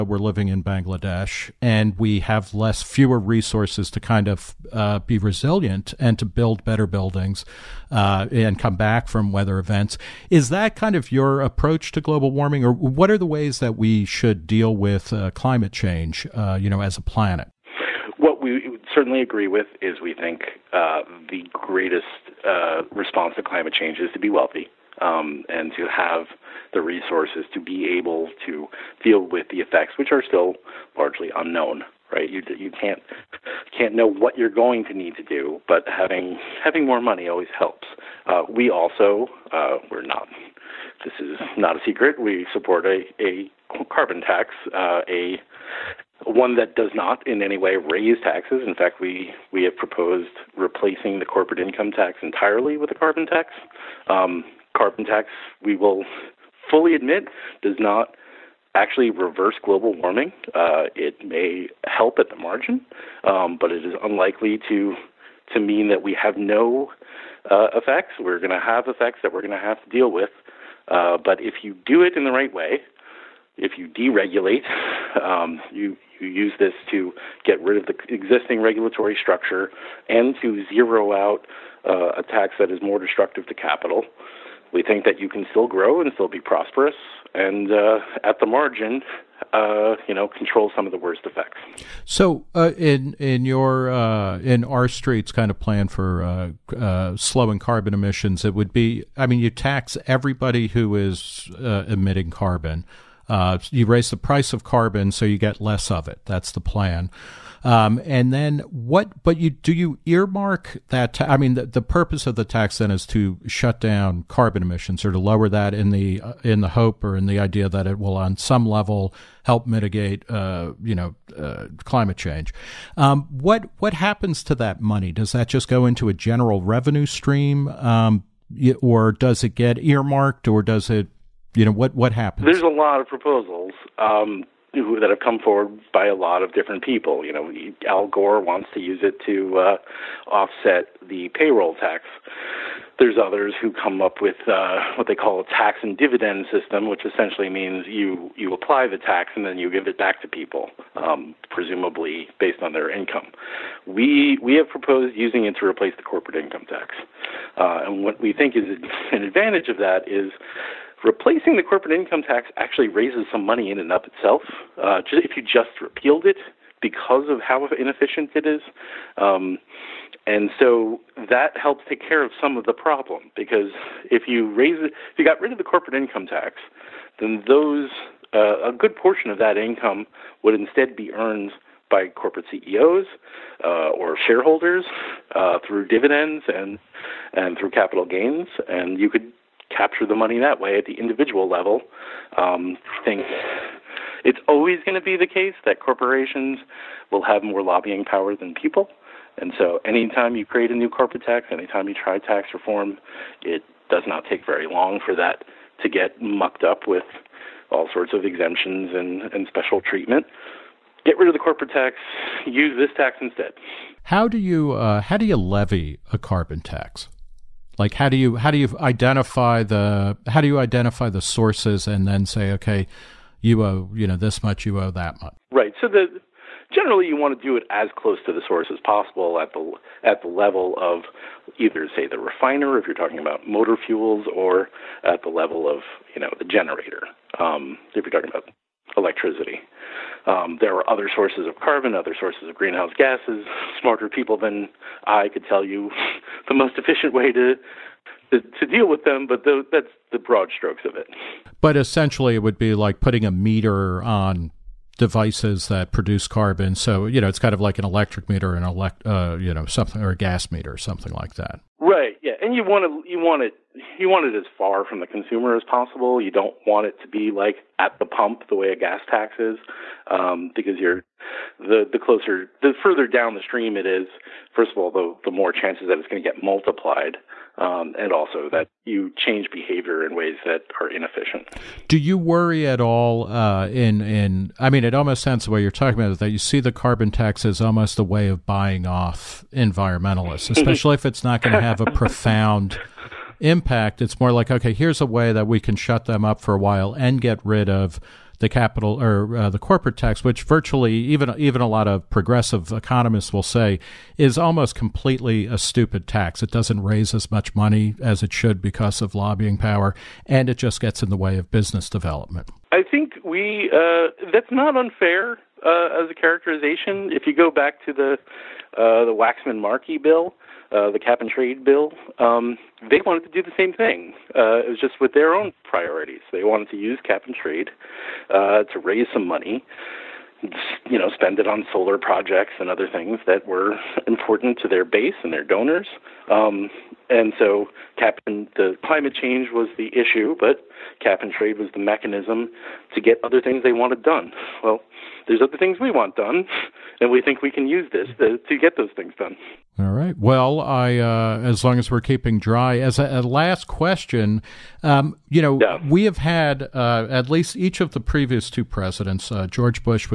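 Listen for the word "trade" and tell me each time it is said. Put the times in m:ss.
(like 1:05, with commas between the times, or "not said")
5:21, 5:27, 5:41.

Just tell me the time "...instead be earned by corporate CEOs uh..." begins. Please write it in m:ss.
3:00.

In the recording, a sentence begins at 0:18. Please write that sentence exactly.
What we certainly agree with is we think uh, the greatest uh, response to climate change is to be wealthy.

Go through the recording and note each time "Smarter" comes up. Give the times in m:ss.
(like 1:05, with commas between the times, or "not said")
4:03.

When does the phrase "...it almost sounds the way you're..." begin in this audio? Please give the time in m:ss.
4:44.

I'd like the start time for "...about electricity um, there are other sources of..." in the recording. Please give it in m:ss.
3:58.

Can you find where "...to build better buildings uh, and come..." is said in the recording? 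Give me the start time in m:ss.
0:06.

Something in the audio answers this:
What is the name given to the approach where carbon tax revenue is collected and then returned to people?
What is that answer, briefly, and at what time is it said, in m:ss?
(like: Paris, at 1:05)
tax and dividend, at 2:25.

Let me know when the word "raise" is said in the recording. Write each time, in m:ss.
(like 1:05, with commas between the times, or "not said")
0:47, 1:43, 2:42, 2:54, 5:06, 5:28.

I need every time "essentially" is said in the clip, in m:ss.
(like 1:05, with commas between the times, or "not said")
2:27, 4:11.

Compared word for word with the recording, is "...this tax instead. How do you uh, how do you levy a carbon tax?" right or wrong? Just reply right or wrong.
right.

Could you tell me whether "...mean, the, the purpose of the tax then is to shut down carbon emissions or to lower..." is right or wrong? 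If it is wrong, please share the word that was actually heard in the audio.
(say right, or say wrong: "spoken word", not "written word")
right.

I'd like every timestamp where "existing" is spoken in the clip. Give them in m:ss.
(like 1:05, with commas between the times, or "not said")
1:18.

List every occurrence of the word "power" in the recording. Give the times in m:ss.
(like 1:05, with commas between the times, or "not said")
3:18, 5:09.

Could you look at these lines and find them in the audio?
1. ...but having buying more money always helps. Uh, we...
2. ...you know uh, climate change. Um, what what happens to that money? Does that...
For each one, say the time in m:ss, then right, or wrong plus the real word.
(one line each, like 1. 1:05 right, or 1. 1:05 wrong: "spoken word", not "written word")
1. 0:35 wrong: "having", not "buying"
2. 2:00 right.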